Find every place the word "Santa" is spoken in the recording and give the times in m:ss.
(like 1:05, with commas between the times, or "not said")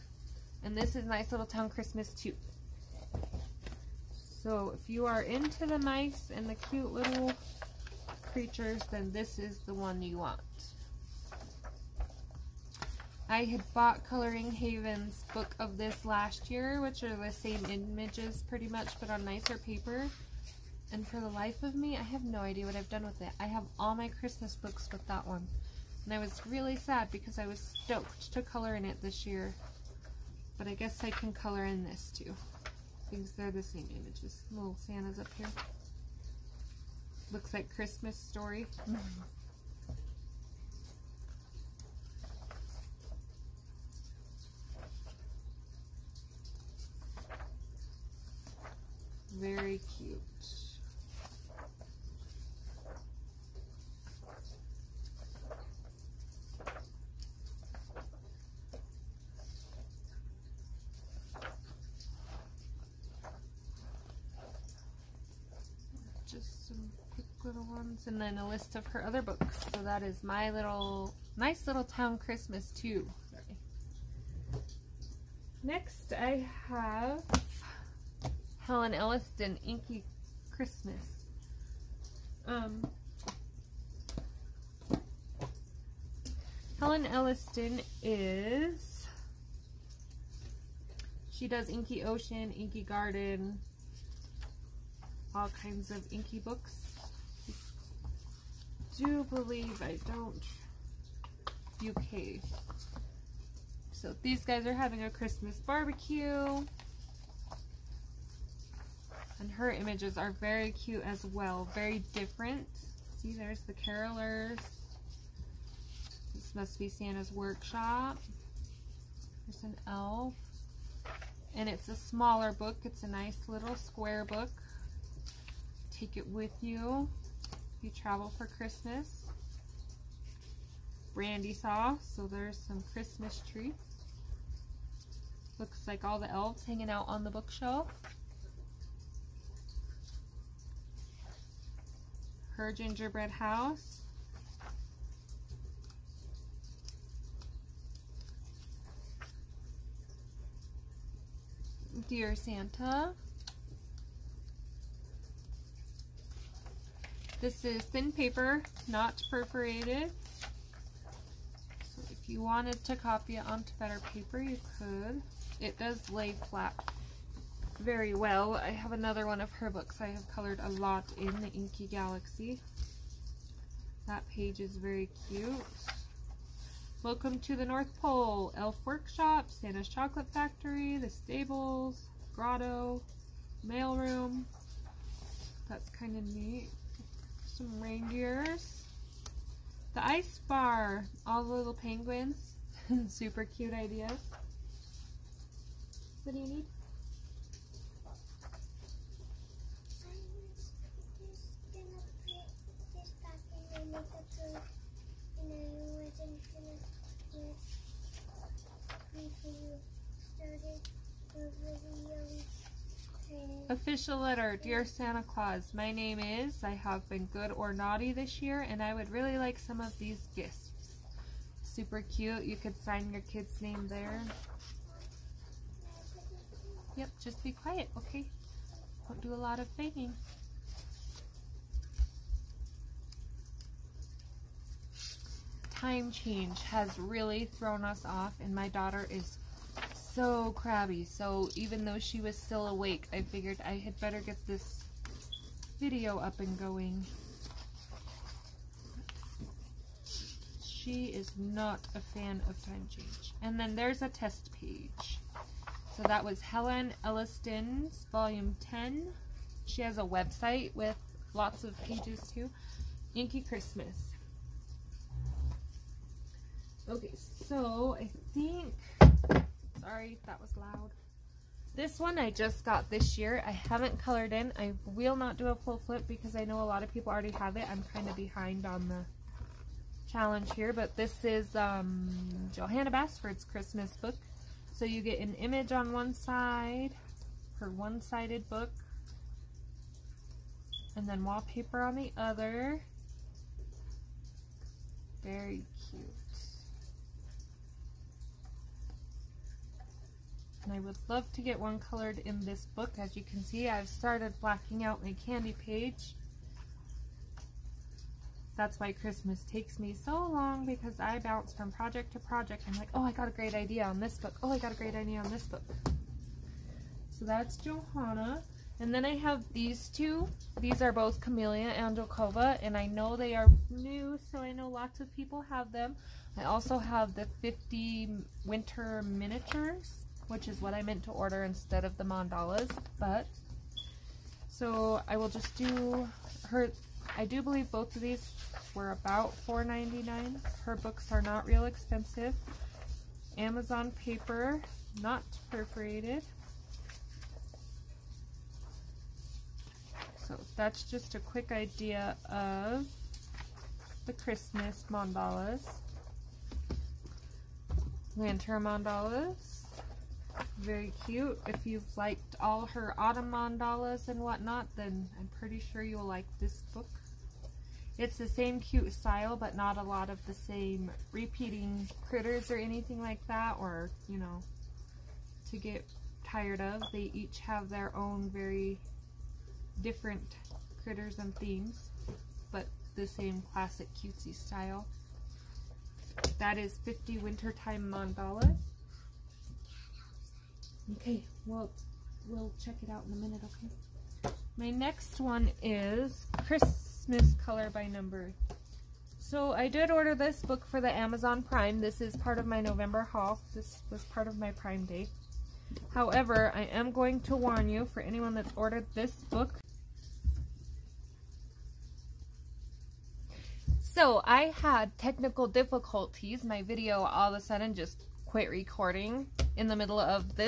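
0:34, 1:56, 2:32, 2:59, 3:34.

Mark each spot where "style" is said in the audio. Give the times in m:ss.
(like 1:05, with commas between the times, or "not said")
6:08, 6:24.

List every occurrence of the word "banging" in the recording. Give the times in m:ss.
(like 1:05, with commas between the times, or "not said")
3:49.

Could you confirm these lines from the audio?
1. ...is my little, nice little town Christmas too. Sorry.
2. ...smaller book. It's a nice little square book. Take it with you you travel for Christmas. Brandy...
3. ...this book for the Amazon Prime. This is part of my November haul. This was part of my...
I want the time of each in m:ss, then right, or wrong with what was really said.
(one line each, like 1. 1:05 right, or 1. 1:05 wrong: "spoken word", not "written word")
1. 1:10 right
2. 2:01 right
3. 6:40 right.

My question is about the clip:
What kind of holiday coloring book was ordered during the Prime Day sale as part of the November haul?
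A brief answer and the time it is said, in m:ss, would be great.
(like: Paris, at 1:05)
Christmas Color by Number, at 6:36.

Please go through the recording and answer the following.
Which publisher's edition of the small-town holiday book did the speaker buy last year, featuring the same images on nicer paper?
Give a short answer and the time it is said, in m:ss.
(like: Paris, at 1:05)
Coloring Haven, at 0:14.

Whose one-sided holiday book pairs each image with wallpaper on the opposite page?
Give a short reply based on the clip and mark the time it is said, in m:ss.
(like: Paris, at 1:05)
Johanna Basford, at 4:42.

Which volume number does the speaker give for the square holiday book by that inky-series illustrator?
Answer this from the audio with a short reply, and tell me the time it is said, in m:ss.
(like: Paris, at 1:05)
10, at 4:18.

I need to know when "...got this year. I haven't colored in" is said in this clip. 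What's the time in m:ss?
4:32.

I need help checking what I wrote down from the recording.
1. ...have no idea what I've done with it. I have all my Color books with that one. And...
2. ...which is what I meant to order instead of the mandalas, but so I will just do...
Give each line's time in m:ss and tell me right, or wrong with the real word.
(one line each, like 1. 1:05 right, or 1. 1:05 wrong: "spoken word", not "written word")
1. 0:22 wrong: "Christmas", not "Color"
2. 5:30 right.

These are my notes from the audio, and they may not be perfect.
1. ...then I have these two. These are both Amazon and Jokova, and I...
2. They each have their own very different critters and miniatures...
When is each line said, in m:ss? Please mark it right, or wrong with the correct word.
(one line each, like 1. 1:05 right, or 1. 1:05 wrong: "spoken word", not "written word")
1. 5:18 wrong: "Camellia", not "Amazon"
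2. 6:16 wrong: "themes", not "miniatures".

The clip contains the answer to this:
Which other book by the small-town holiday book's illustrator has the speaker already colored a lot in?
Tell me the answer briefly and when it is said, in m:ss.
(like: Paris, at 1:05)
Inky Galaxy, at 2:51.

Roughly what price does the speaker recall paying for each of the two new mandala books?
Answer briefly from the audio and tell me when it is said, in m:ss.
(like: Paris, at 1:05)
$4.99, at 5:39.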